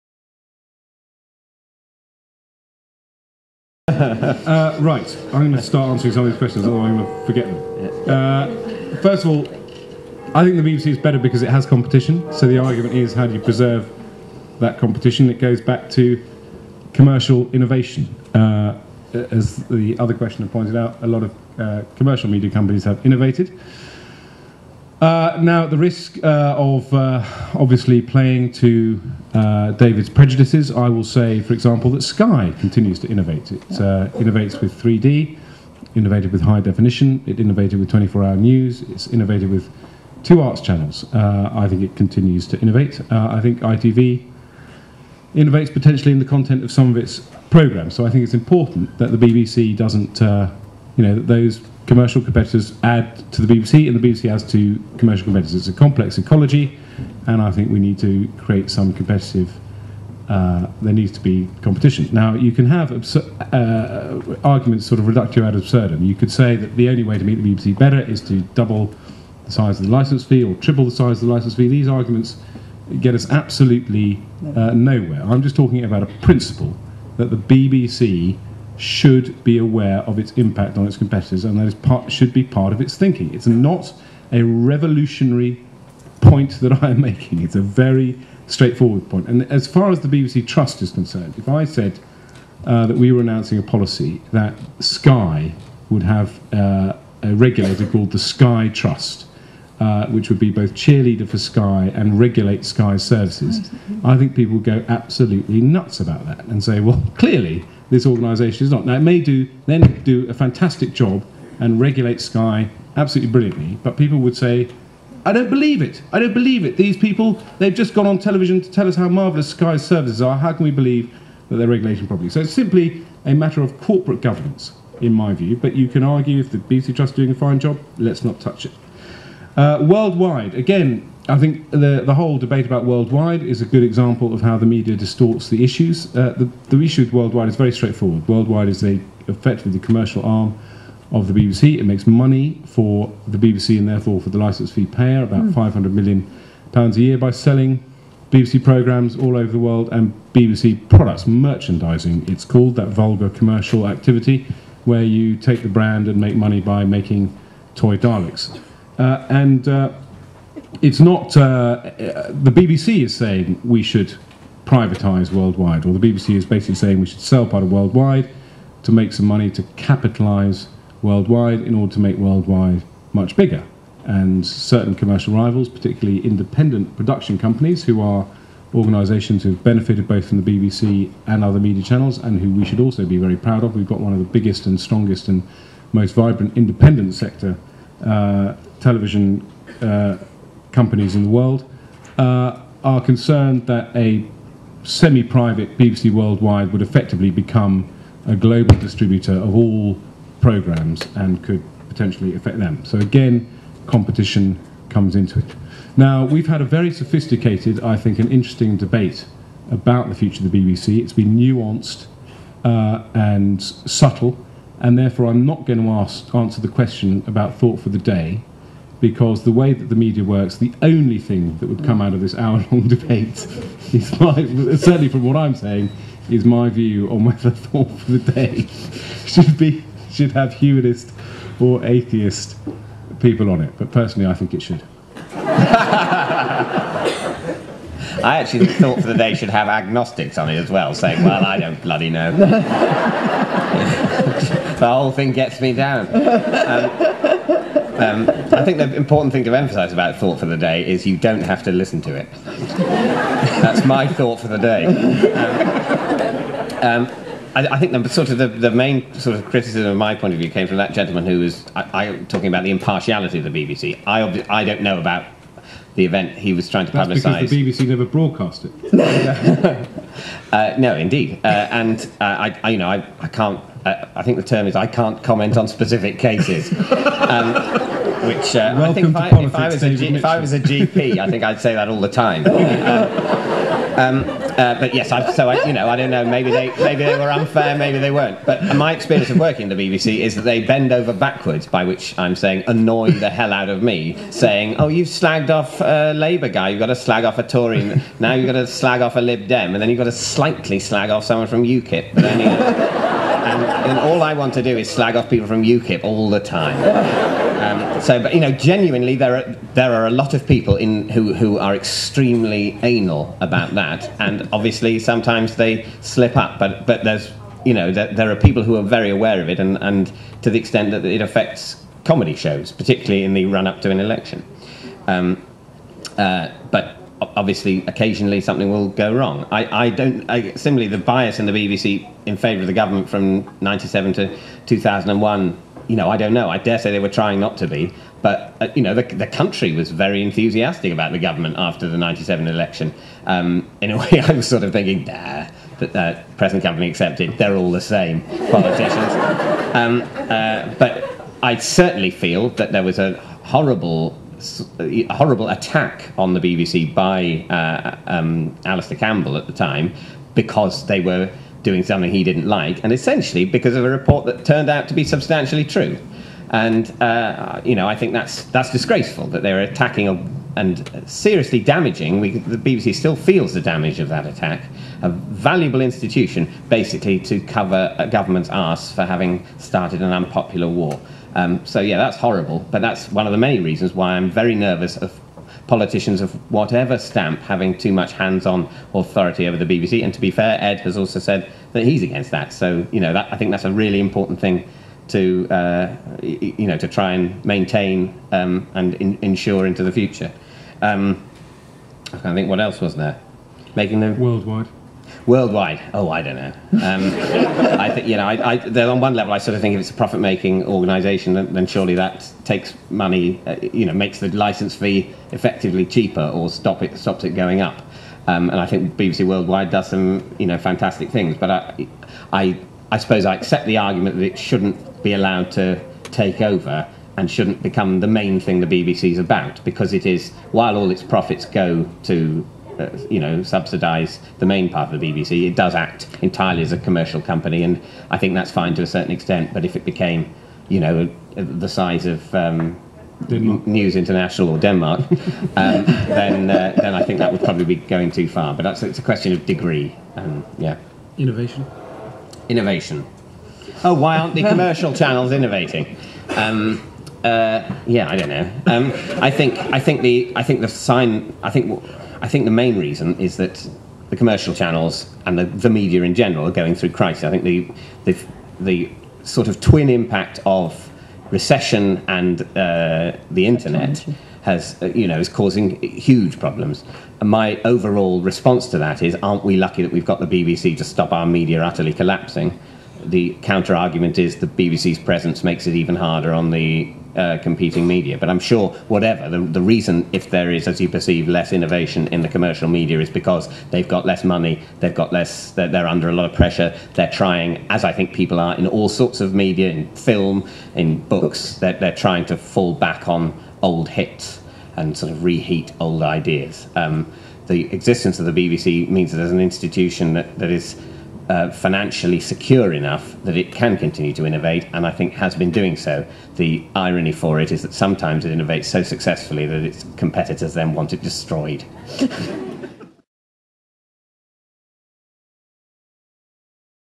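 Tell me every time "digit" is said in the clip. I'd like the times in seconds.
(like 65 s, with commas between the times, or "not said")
not said.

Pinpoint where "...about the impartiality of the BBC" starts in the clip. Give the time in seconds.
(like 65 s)
262 s.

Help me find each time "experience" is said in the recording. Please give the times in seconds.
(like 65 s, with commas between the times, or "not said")
288 s.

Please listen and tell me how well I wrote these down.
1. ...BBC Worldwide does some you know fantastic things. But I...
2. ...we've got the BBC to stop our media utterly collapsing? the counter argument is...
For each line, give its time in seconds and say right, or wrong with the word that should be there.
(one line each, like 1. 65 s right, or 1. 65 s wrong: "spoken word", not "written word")
1. 418 s right
2. 479 s right.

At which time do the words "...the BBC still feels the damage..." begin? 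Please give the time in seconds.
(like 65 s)
372 s.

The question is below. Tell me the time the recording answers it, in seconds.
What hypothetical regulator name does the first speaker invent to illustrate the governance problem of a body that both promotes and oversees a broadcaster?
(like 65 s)
98 s.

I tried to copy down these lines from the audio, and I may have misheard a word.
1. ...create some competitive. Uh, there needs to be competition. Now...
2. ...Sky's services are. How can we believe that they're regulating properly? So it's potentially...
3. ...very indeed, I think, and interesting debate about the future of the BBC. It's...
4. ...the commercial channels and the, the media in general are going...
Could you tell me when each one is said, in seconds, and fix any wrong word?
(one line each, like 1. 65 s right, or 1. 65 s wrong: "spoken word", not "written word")
1. 58 s right
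2. 119 s wrong: "simply", not "potentially"
3. 206 s wrong: "sophisticated", not "indeed"
4. 464 s right.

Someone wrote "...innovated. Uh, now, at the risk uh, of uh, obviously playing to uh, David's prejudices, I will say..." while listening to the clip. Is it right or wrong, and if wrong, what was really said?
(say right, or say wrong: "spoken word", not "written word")
right.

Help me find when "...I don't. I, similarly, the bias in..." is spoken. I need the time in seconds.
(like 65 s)
329 s.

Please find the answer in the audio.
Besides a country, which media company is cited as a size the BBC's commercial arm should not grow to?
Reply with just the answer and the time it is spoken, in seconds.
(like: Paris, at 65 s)
News International, at 443 s.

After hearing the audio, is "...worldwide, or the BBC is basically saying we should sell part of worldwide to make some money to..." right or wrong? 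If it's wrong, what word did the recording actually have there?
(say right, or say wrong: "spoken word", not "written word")
right.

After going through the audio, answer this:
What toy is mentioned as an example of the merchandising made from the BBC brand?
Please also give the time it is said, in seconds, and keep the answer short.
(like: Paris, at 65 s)
Daleks, at 157 s.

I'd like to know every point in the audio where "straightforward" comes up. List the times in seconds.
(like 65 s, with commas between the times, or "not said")
88 s, 137 s.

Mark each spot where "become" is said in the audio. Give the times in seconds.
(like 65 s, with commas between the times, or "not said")
197 s, 427 s.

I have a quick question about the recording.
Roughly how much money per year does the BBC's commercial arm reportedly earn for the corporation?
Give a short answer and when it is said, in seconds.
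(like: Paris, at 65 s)
500 million pounds, at 145 s.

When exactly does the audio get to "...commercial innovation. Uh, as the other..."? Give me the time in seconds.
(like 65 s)
16 s.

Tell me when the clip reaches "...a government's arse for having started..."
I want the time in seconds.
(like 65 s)
377 s.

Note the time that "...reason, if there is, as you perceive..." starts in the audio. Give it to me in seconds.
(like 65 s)
489 s.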